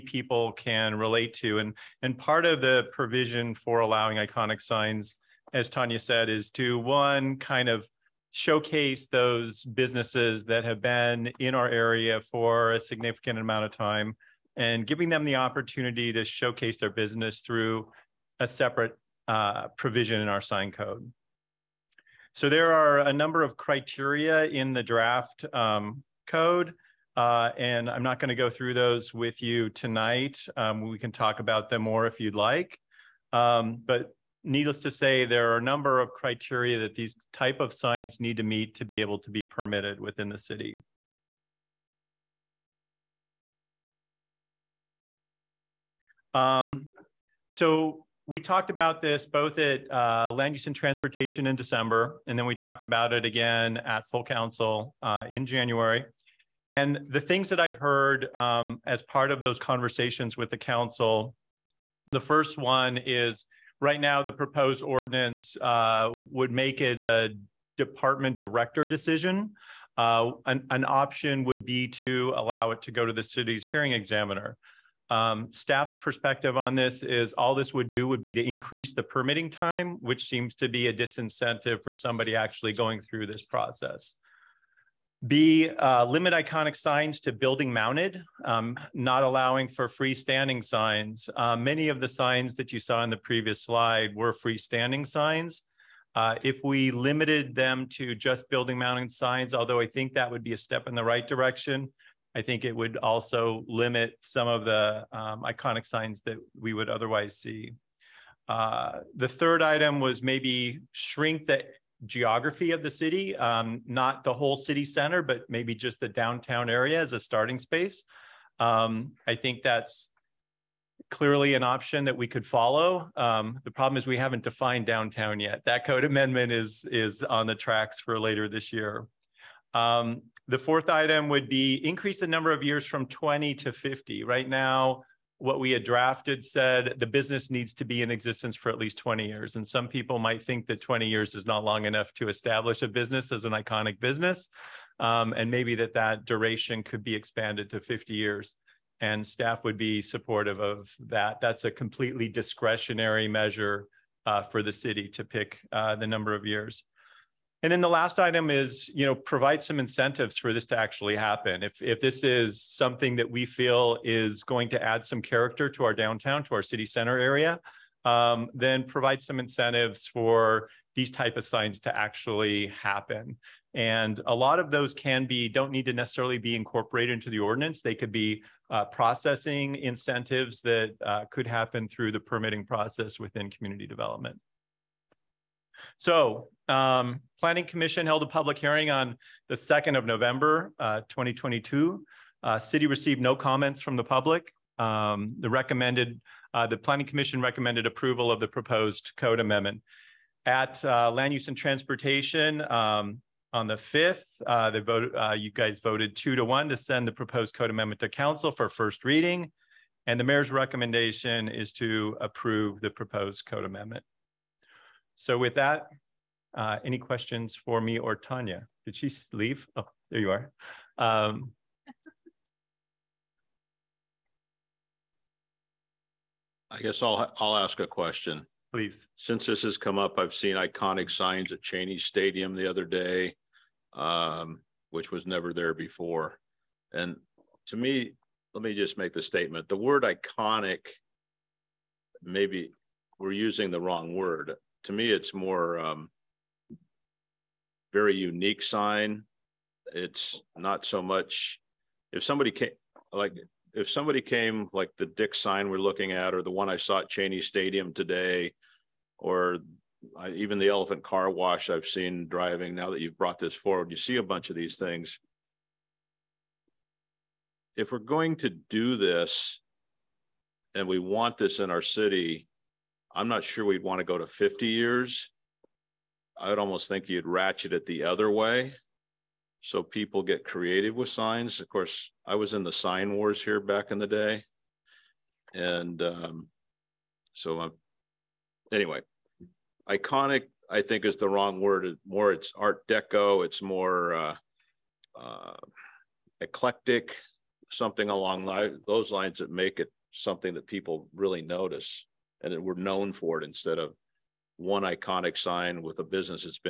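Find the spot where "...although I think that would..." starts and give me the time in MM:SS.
01:39.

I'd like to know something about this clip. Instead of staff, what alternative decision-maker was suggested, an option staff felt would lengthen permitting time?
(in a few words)
Hearing examiner.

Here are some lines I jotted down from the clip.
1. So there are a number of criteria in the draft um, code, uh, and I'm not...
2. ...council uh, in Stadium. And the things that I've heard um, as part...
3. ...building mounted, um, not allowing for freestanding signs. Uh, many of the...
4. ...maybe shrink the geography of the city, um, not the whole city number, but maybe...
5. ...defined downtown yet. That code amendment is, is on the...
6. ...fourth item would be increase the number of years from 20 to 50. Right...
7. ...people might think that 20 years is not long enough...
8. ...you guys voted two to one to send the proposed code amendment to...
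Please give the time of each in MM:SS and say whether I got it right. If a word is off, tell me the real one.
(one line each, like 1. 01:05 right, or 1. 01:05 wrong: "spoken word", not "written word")
1. 00:22 right
2. 00:54 wrong: "January", not "Stadium"
3. 01:27 right
4. 01:50 wrong: "center", not "number"
5. 02:04 right
6. 02:10 right
7. 02:19 right
8. 03:25 right.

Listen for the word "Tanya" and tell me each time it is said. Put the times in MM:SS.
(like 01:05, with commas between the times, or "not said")
00:05, 03:38.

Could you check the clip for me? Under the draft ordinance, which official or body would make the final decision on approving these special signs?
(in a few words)
Department director.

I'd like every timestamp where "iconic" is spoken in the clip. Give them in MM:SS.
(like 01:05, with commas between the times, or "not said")
00:04, 01:26, 01:45, 02:23, 03:50, 04:00, 04:49, 05:04.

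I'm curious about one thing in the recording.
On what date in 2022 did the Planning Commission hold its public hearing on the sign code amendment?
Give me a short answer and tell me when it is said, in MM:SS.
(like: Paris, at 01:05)
November 2, at 03:09.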